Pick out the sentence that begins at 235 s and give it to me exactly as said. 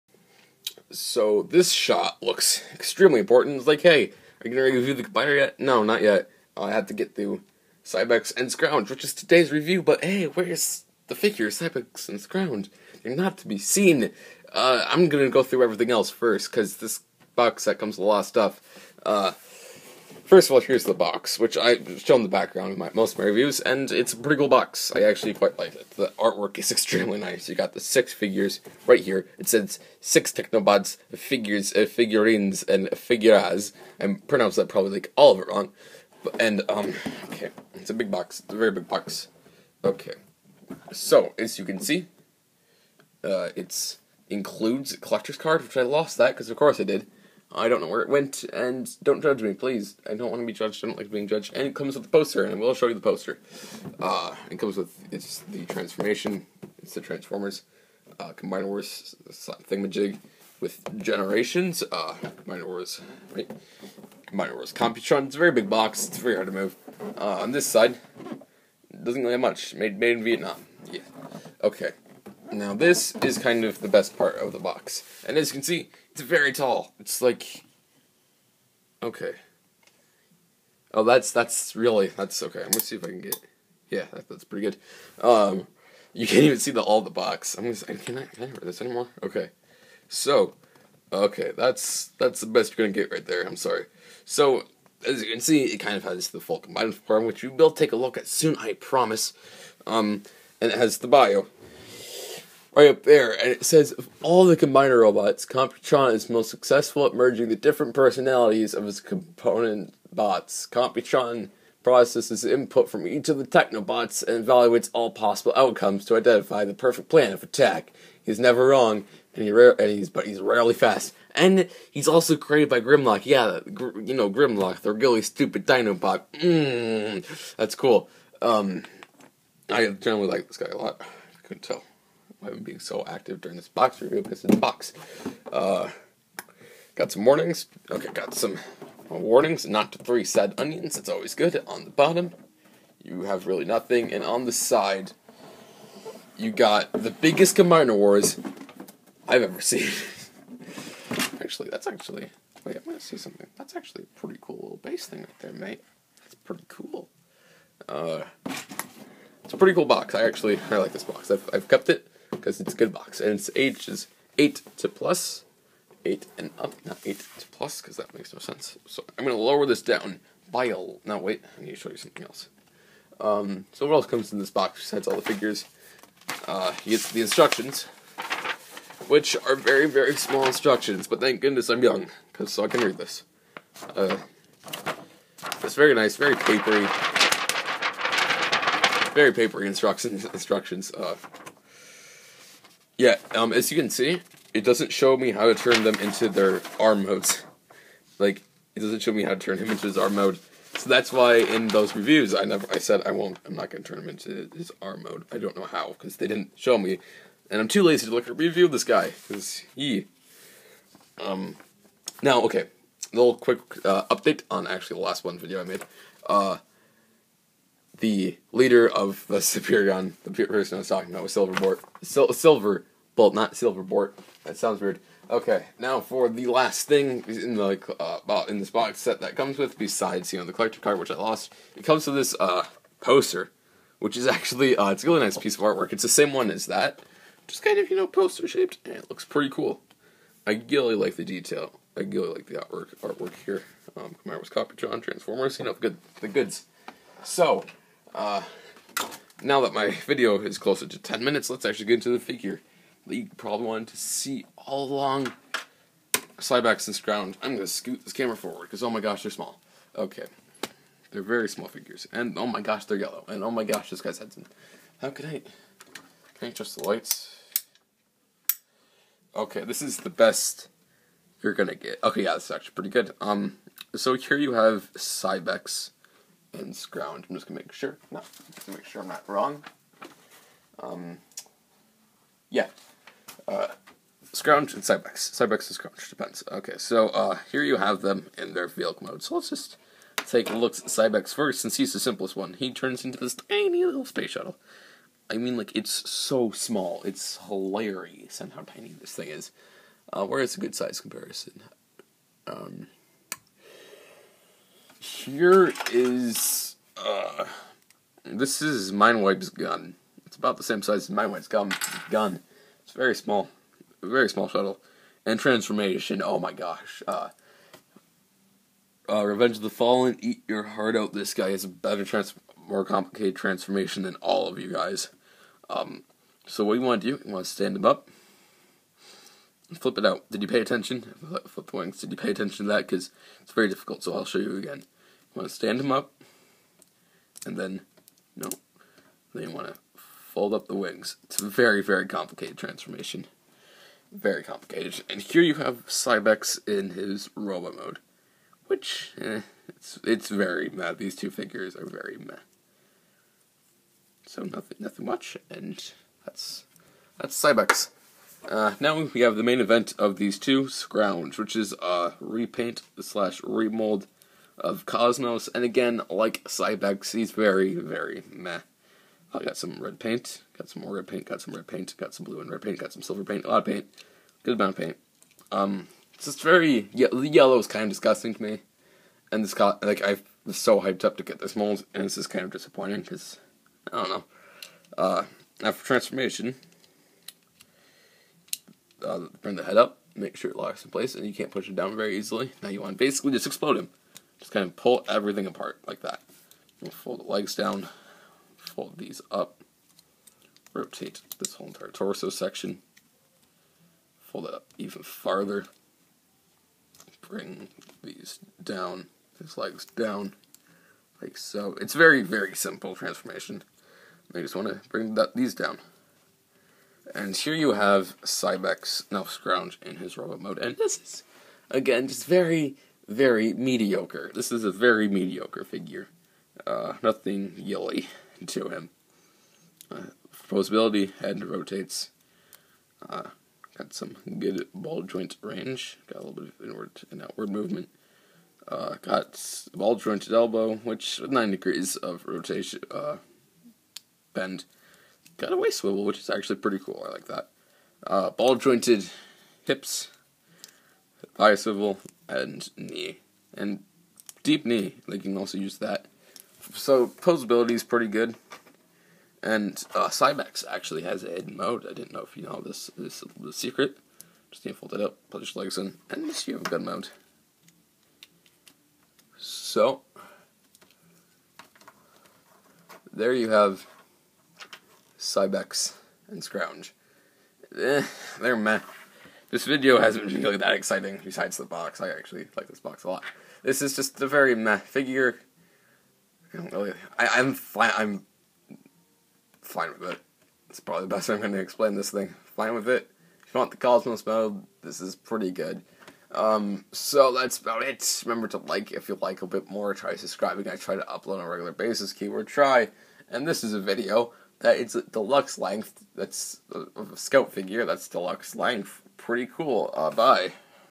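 It's the same one as that, just kind of you know poster shaped, and it looks pretty cool.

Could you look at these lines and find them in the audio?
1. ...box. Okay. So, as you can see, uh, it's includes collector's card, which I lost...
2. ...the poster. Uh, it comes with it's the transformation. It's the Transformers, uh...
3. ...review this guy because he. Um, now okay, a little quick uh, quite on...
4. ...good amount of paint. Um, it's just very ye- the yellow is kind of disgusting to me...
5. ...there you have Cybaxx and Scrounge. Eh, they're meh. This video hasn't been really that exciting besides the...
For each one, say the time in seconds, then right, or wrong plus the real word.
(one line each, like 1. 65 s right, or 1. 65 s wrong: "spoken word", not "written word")
1. 38 s right
2. 52 s right
3. 208 s wrong: "update", not "quite"
4. 374 s right
5. 473 s right.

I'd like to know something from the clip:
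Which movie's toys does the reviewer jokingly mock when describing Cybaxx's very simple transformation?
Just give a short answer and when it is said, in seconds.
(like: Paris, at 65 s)
Revenge of the Fallen, at 319 s.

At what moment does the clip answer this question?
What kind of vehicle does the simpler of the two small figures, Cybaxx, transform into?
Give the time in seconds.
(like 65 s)
294 s.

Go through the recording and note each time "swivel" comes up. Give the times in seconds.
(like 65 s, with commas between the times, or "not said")
445 s, 451 s.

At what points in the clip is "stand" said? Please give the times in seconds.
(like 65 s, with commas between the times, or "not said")
327 s, 335 s.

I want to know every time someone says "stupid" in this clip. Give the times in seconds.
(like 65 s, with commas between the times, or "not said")
125 s.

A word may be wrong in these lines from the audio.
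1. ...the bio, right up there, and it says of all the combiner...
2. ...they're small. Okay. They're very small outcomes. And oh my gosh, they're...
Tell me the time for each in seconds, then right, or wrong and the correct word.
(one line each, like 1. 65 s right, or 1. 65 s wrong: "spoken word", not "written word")
1. 100 s right
2. 259 s wrong: "figures", not "outcomes".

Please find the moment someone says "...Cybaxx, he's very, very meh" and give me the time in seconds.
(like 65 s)
366 s.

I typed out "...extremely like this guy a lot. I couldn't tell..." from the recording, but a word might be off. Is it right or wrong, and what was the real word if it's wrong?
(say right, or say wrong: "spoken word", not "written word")
wrong: "generally", not "extremely".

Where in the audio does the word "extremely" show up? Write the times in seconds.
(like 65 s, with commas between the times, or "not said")
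2 s, 26 s.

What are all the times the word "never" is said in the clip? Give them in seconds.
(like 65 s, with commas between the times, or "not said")
118 s, 202 s.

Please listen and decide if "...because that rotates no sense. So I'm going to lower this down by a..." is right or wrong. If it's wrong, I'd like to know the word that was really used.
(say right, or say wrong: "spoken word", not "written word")
wrong: "makes", not "rotates".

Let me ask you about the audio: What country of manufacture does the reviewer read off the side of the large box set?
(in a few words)
Vietnam.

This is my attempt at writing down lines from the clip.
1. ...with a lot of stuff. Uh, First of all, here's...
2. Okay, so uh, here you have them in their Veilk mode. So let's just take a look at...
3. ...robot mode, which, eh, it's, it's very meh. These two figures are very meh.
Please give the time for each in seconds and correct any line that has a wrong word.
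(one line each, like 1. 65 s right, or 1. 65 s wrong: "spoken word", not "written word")
1. 17 s right
2. 286 s right
3. 347 s right.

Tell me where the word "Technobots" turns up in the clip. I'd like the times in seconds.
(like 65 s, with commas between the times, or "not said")
30 s, 113 s.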